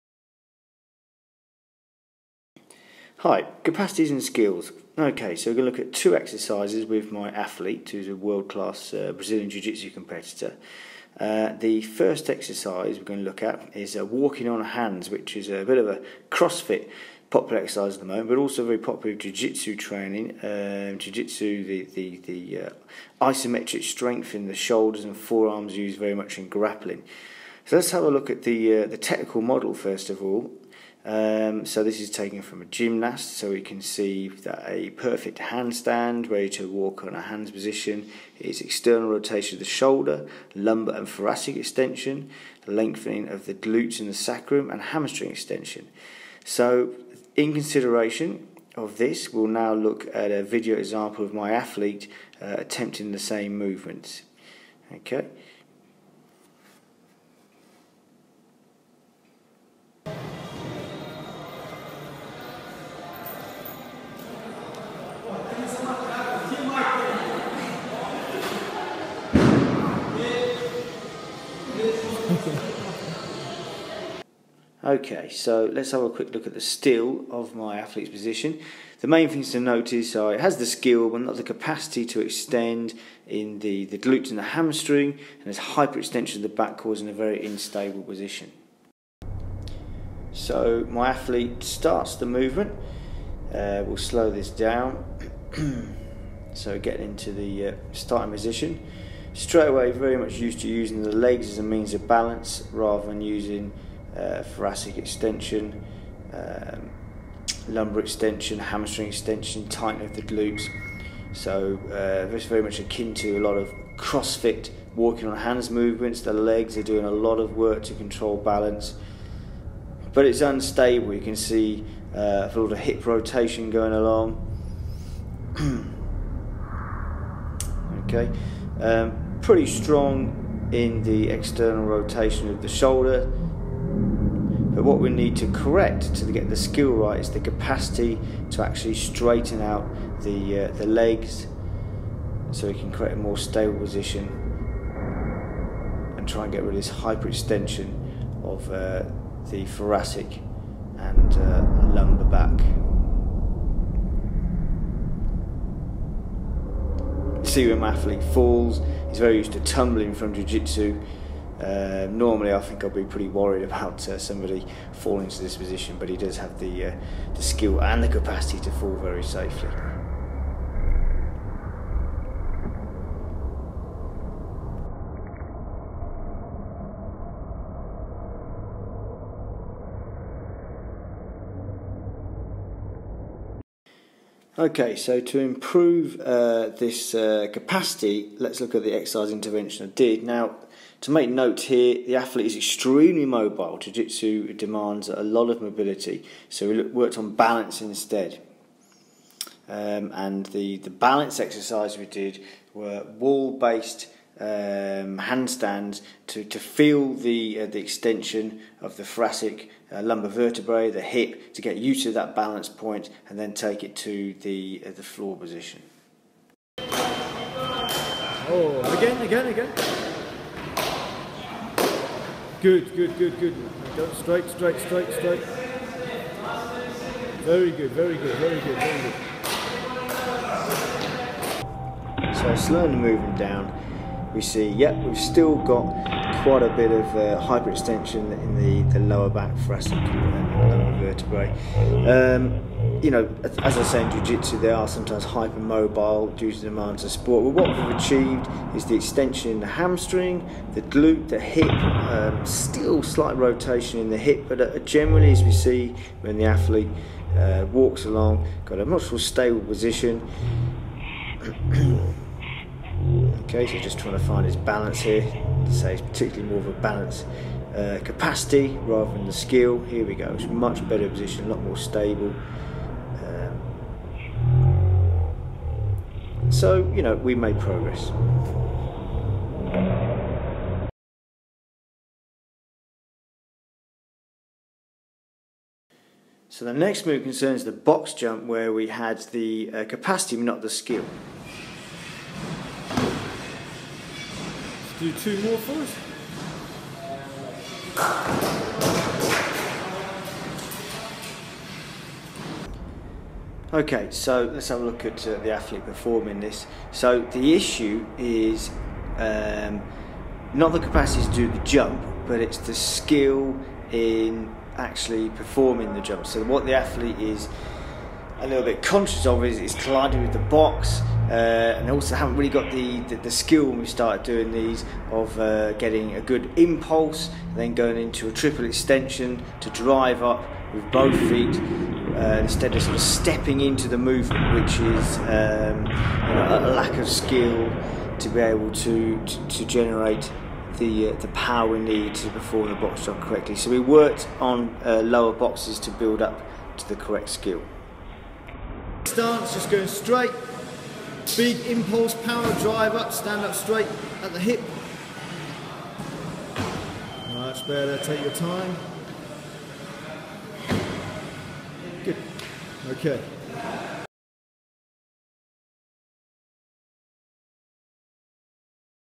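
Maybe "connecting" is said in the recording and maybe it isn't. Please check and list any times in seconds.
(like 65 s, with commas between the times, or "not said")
not said.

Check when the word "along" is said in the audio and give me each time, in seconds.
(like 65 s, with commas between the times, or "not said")
123 s, 258 s.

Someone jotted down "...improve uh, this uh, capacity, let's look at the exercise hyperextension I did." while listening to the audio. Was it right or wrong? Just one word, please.
wrong.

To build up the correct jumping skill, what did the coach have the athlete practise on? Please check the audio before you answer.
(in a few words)
Lower boxes.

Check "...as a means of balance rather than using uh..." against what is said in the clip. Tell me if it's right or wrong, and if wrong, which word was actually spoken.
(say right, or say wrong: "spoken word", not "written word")
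right.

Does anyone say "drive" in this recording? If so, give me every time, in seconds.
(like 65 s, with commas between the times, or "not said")
329 s, 352 s.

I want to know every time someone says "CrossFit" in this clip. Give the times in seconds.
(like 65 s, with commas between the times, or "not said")
16 s, 113 s.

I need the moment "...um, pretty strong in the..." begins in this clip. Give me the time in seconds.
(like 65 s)
128 s.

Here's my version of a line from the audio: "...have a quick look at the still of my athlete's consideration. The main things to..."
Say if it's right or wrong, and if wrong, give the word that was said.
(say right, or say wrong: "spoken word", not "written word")
wrong: "position", not "consideration".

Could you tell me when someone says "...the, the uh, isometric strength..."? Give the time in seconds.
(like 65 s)
21 s.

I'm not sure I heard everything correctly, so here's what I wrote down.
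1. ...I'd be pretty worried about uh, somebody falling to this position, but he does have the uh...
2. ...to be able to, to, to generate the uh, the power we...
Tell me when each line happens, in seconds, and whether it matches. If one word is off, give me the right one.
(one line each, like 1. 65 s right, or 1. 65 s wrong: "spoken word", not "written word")
1. 162 s right
2. 338 s right.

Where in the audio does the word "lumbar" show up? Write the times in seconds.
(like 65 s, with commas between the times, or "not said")
40 s, 107 s, 151 s, 210 s.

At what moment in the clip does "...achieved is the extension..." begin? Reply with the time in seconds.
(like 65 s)
247 s.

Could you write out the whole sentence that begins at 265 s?
Say it's particularly more of a balance uh, capacity rather than the skill.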